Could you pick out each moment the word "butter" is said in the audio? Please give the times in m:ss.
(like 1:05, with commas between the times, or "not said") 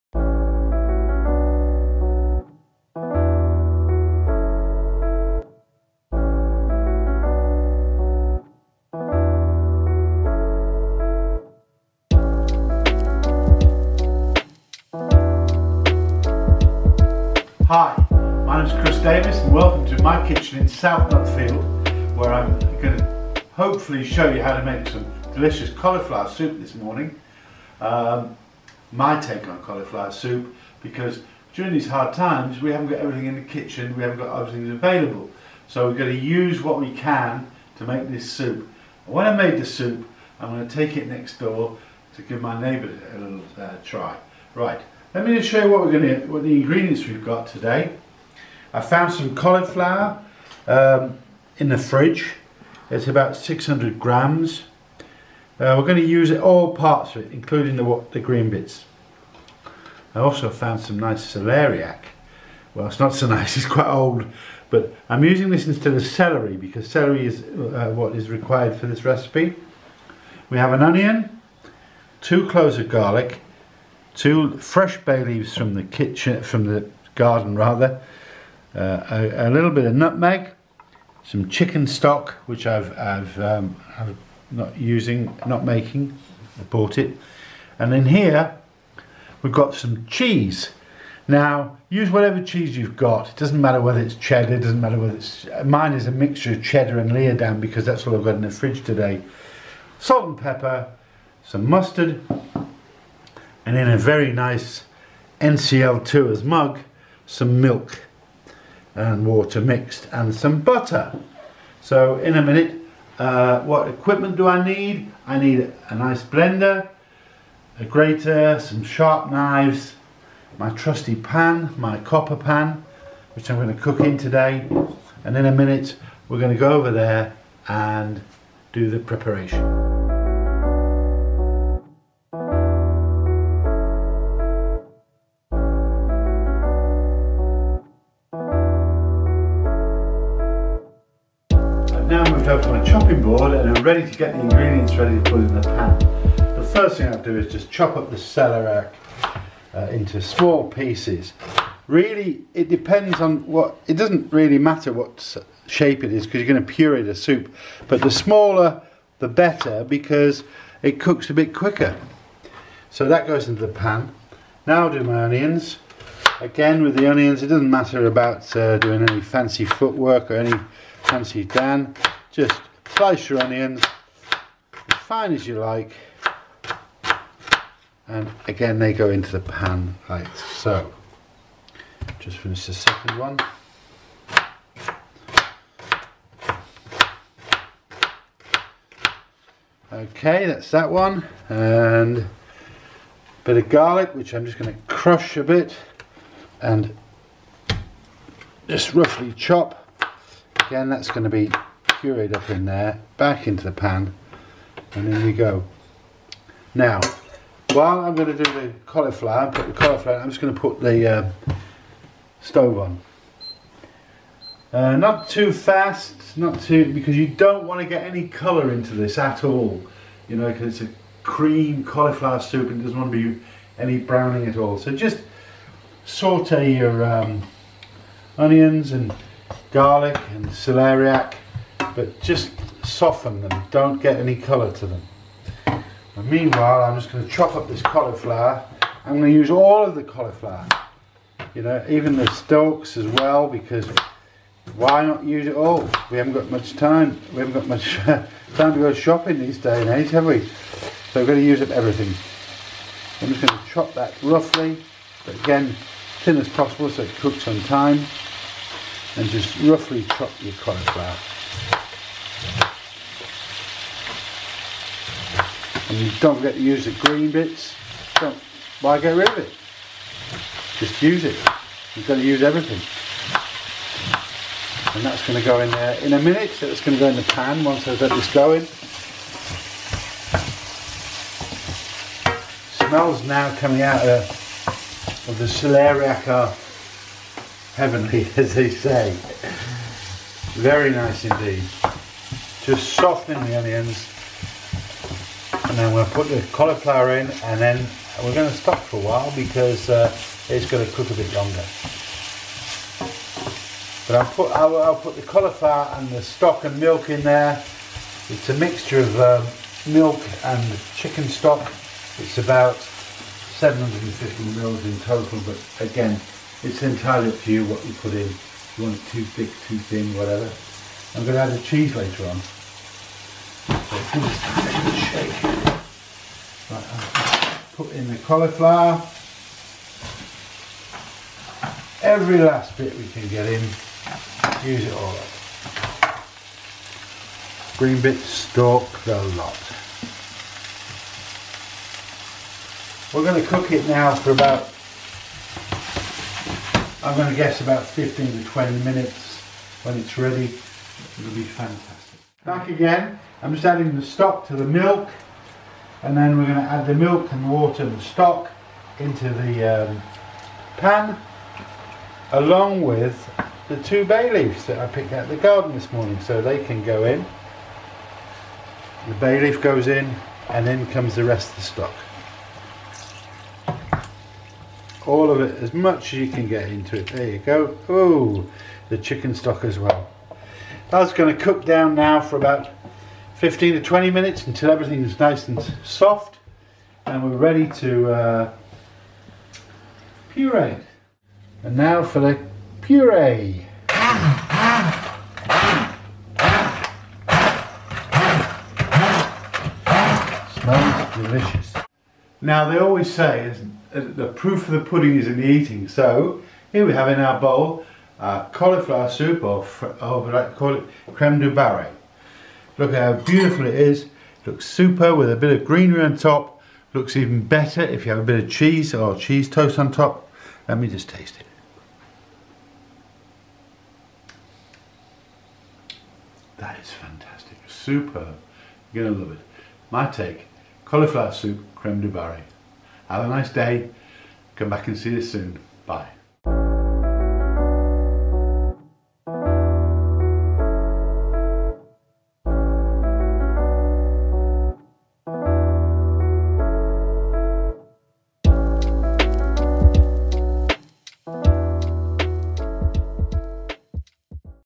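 1:50.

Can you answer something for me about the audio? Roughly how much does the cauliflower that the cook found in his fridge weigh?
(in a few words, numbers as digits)
600 grams.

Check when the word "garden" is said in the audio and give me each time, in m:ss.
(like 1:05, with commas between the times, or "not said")
1:17, 6:05.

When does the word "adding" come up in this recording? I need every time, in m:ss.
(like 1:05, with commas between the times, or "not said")
5:53.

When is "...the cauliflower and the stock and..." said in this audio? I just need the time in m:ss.
5:05.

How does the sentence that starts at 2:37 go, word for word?
But the smaller, the better because it cooks a bit quicker.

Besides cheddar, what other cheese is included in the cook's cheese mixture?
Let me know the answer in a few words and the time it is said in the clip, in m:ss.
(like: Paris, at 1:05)
Leodam, at 1:37.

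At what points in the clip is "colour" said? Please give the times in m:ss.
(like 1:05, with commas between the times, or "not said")
3:38, 3:54.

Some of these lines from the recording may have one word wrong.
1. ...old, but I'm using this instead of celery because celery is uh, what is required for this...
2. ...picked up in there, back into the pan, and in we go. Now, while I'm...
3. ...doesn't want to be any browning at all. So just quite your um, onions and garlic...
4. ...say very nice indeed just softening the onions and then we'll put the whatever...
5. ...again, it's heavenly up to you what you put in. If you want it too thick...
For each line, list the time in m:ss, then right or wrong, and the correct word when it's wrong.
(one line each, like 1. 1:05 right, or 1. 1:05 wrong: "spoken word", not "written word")
1. 1:03 right
2. 3:22 wrong: "pureed", not "picked"
3. 3:42 wrong: "saute", not "quite"
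4. 4:48 wrong: "cauliflower", not "whatever"
5. 5:15 wrong: "entirely", not "heavenly".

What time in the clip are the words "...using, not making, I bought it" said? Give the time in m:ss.
1:24.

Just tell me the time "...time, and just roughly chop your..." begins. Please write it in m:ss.
4:17.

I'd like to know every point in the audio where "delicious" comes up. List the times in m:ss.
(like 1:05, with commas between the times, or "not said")
0:25, 6:41.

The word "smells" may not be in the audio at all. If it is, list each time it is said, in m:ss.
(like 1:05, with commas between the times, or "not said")
4:42, 6:40.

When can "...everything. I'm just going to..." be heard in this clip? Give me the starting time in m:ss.
4:11.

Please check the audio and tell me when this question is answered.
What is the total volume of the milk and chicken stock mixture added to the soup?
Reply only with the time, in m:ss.
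5:12.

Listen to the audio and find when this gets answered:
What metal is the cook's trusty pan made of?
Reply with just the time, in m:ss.
2:01.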